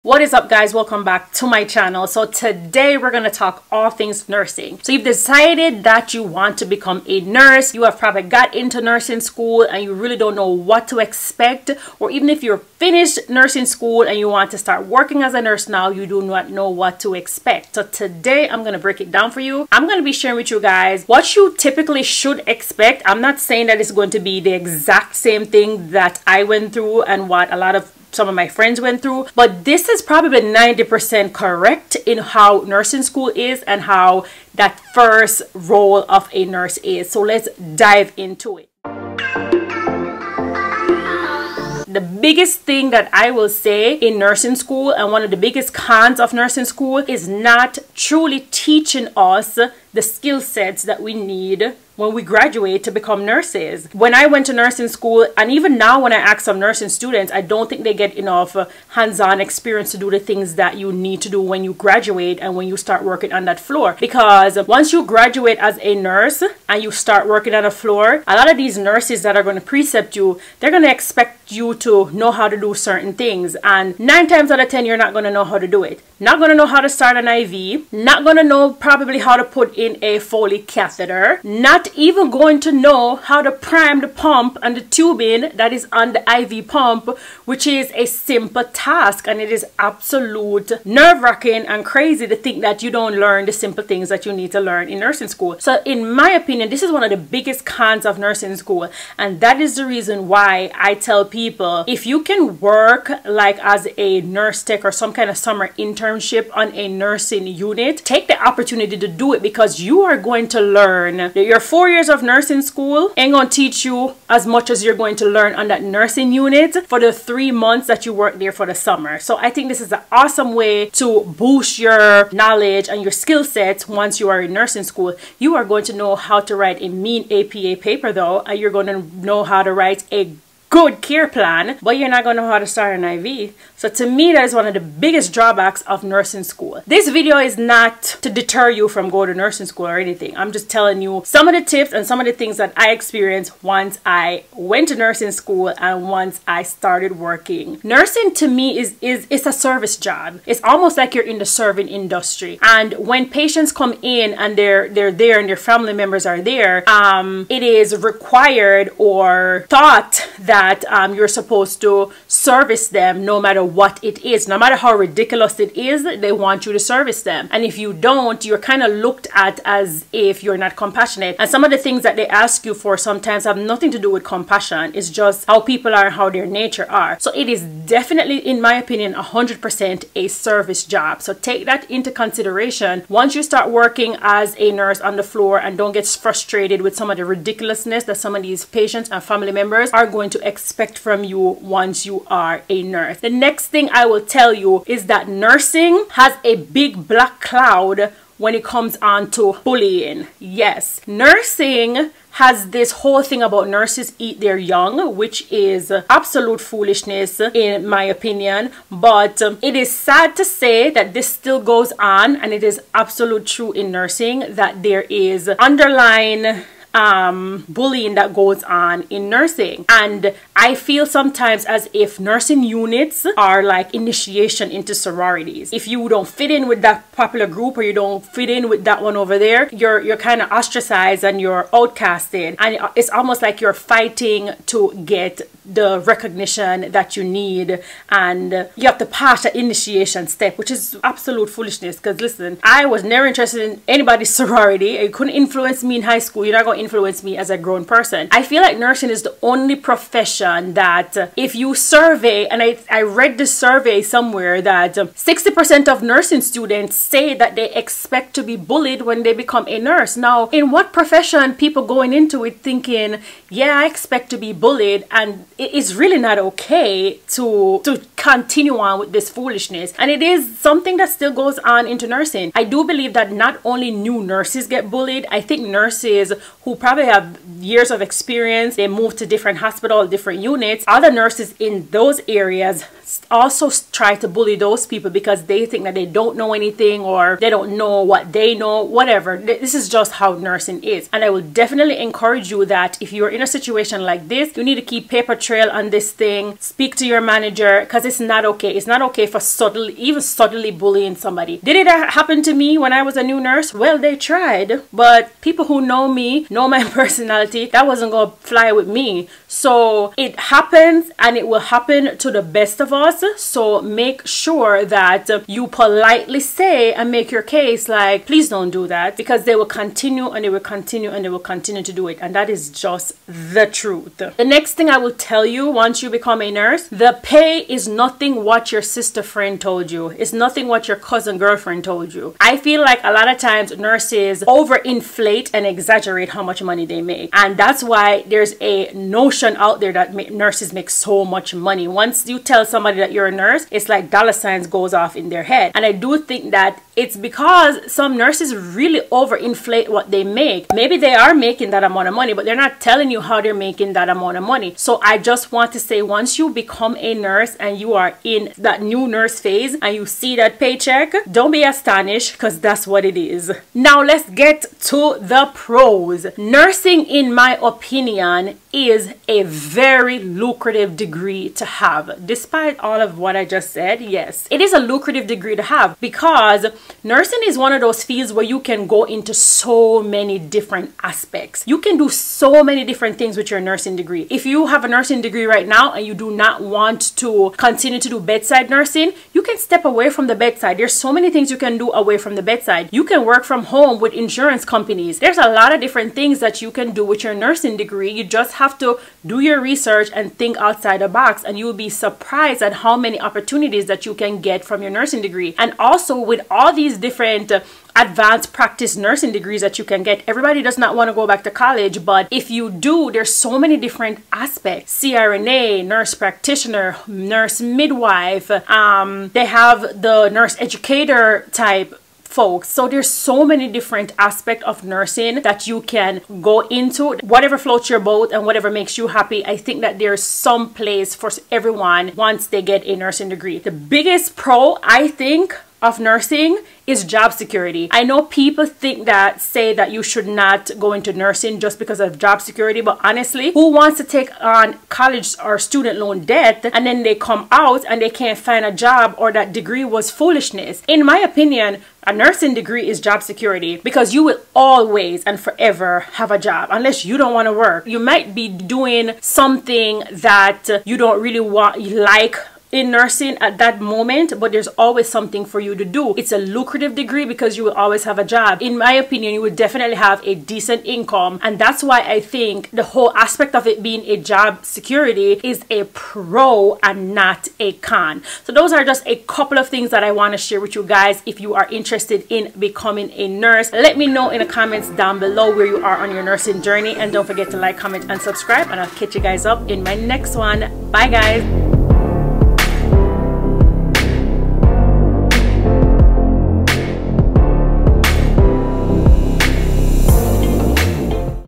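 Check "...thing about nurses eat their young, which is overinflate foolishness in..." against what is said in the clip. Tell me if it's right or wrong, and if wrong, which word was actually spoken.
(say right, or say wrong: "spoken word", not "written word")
wrong: "absolute", not "overinflate".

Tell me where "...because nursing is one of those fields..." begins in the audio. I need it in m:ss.
6:16.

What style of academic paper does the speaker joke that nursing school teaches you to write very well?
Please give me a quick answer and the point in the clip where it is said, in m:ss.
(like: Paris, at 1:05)
APA paper, at 2:07.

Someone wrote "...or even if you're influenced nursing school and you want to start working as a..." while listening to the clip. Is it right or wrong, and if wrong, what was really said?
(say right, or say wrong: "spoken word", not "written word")
wrong: "finished", not "influenced".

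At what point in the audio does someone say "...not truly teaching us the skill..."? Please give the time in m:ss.
0:47.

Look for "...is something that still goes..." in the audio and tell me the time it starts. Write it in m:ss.
4:30.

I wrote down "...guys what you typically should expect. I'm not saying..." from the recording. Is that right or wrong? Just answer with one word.
right.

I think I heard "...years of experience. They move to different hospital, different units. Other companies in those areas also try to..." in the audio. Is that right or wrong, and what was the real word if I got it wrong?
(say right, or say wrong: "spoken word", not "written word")
wrong: "nurses", not "companies".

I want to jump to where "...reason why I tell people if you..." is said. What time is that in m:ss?
1:39.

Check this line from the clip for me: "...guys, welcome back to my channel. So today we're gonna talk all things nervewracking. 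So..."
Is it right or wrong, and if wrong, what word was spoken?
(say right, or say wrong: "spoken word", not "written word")
wrong: "nursing", not "nervewracking".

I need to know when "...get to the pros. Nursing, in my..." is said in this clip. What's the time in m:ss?
6:04.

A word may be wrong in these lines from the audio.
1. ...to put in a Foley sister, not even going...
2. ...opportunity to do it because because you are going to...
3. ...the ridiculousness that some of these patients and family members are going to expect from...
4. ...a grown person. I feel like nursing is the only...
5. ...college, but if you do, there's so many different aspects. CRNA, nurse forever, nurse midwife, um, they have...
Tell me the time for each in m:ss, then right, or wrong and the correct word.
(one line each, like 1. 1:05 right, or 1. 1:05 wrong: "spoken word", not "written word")
1. 1:19 wrong: "catheter", not "sister"
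2. 1:48 right
3. 3:07 right
4. 4:07 right
5. 6:51 wrong: "practitioner", not "forever".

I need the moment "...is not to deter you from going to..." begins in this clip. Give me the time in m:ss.
2:17.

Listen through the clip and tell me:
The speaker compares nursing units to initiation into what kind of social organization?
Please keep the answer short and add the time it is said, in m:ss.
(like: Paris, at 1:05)
Sororities, at 3:44.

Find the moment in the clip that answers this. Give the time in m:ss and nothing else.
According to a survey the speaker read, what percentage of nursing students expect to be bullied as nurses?
4:14.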